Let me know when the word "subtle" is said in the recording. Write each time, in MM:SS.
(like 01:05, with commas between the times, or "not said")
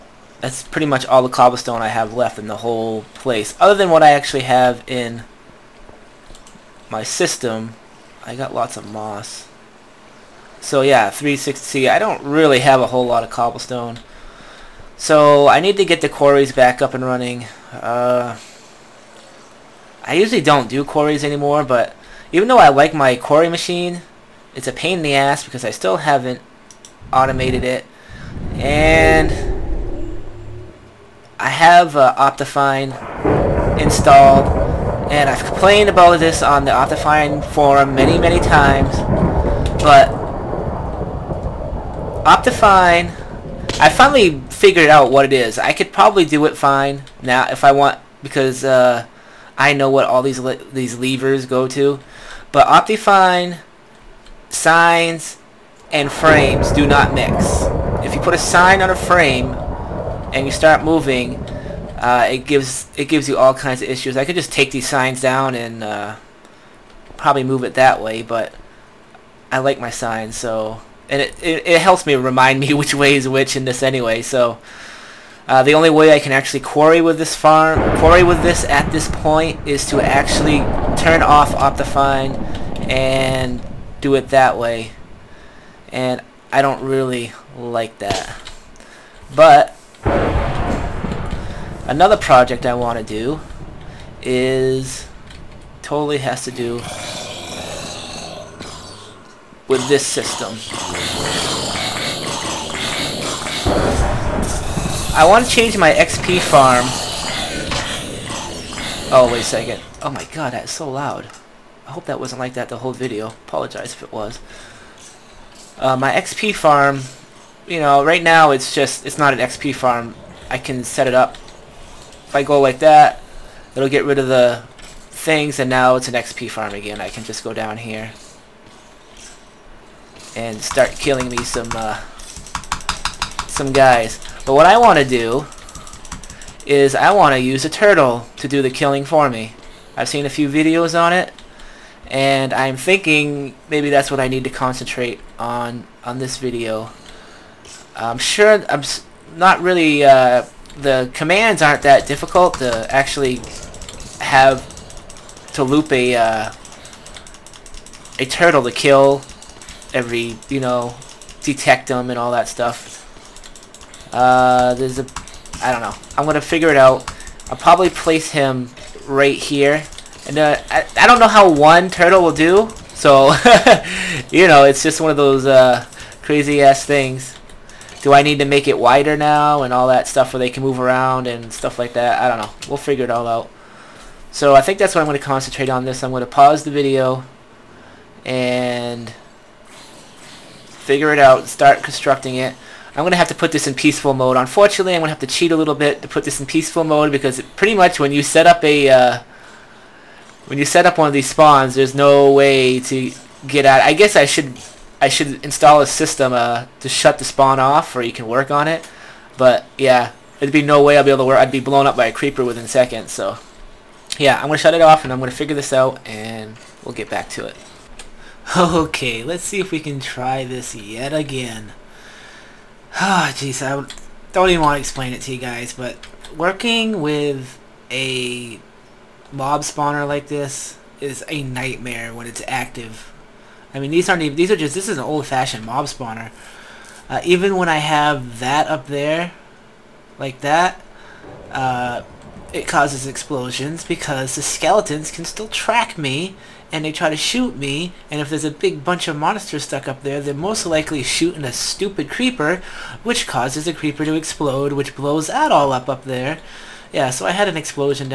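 not said.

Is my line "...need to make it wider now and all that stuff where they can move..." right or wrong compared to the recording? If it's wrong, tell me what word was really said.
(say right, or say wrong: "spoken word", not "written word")
right.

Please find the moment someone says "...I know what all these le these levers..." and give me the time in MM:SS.
00:49.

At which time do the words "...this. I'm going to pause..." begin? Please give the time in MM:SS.
03:05.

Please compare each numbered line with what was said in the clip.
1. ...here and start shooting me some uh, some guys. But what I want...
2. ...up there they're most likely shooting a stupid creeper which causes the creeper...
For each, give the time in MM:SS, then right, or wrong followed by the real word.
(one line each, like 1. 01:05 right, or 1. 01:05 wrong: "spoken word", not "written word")
1. 02:07 wrong: "killing", not "shooting"
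2. 04:09 right.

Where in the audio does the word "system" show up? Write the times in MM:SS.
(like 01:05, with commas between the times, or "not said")
00:07, 01:40, 03:25.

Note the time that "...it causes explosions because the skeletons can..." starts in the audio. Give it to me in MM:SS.
04:02.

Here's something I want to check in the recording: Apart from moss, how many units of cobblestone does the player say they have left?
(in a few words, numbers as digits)
360.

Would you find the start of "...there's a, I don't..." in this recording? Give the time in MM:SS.
02:44.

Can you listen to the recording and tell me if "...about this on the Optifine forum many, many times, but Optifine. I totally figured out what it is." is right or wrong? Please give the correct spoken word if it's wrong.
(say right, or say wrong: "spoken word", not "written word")
wrong: "finally", not "totally".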